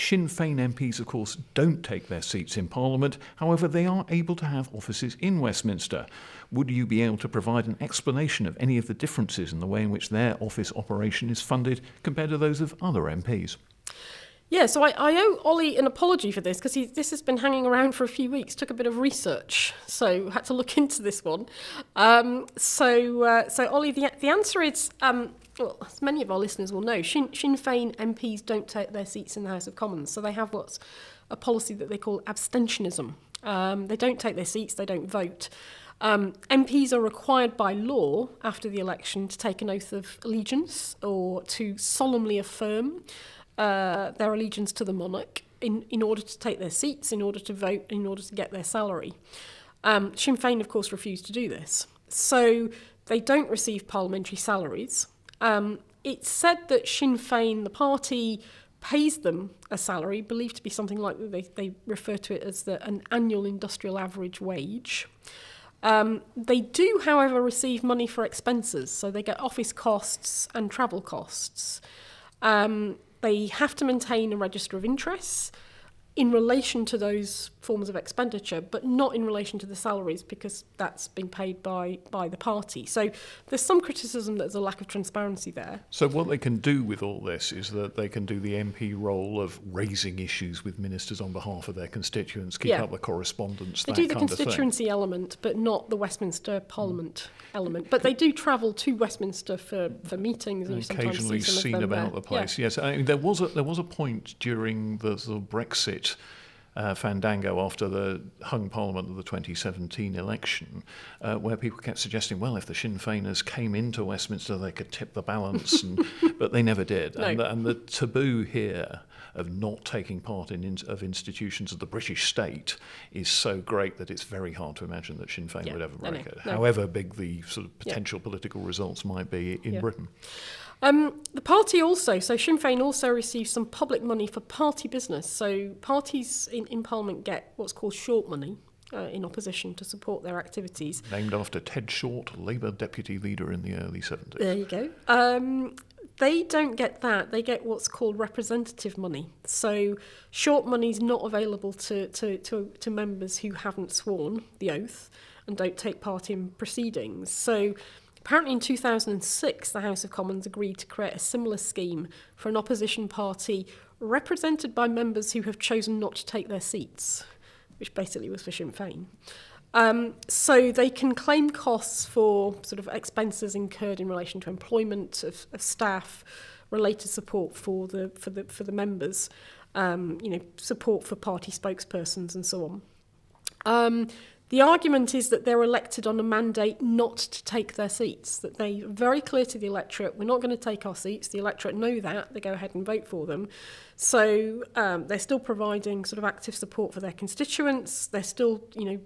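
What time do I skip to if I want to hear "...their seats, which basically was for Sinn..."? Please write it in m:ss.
2:46.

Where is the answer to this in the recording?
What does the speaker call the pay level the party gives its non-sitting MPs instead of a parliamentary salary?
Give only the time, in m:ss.
1:03.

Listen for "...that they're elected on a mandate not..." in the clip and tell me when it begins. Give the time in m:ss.
3:05.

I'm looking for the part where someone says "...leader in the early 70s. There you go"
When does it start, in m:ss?
2:23.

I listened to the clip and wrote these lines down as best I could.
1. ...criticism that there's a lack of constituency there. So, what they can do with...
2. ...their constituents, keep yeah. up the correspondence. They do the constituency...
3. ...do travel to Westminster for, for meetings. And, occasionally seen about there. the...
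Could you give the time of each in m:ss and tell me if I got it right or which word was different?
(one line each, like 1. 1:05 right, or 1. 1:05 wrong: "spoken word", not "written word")
1. 1:23 wrong: "transparency", not "constituency"
2. 1:31 right
3. 1:38 right.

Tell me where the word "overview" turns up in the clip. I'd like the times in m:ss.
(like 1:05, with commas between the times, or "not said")
not said.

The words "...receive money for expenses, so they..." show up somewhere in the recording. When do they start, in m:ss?
1:07.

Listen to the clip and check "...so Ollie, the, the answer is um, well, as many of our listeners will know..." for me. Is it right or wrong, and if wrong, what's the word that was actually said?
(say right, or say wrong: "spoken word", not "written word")
right.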